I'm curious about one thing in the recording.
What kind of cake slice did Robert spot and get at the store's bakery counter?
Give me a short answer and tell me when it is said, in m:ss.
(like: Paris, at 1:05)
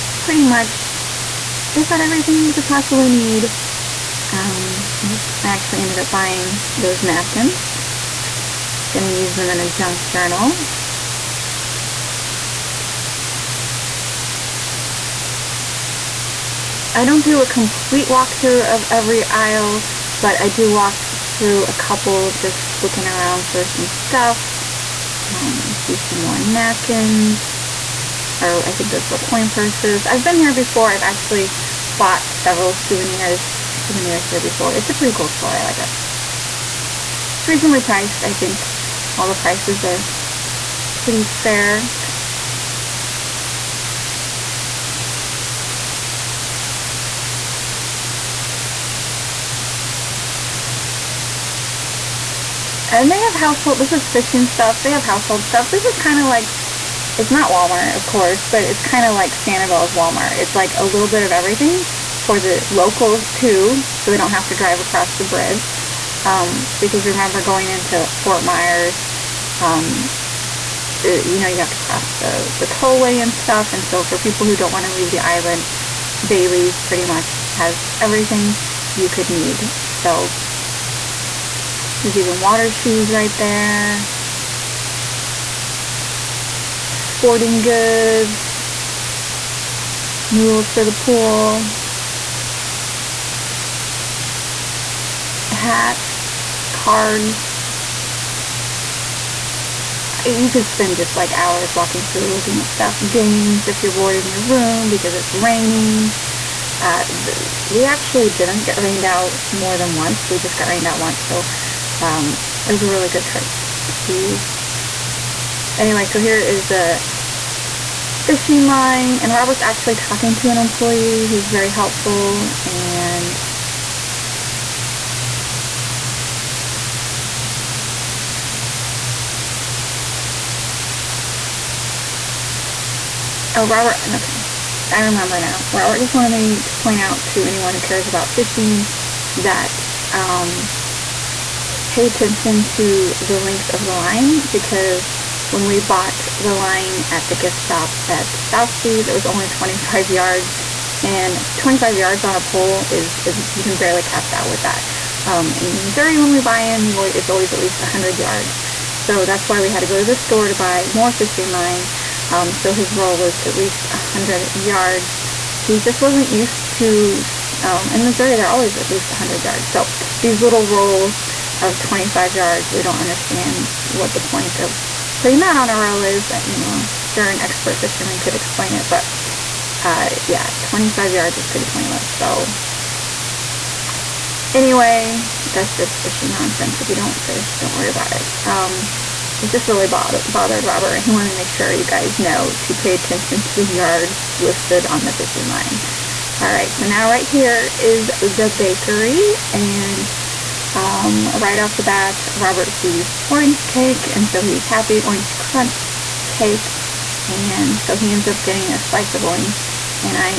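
Orange crunch cake, at 3:24.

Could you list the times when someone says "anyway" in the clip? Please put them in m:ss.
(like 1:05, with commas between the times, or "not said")
1:55, 3:04.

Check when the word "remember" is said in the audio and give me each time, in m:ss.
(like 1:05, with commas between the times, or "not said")
1:07, 2:15.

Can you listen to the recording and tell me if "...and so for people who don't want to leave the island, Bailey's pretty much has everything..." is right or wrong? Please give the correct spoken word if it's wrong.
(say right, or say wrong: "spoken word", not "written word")
right.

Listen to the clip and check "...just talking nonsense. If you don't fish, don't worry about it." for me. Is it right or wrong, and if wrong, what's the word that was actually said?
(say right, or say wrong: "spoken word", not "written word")
wrong: "fishing", not "talking".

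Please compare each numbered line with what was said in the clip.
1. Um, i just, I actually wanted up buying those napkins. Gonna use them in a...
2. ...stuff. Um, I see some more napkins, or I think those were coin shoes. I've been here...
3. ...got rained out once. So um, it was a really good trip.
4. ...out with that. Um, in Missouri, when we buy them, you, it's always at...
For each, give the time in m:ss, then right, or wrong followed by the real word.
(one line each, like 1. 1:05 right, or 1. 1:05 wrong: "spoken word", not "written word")
1. 0:04 wrong: "ended", not "wanted"
2. 0:24 wrong: "purses", not "shoes"
3. 1:50 right
4. 2:34 right.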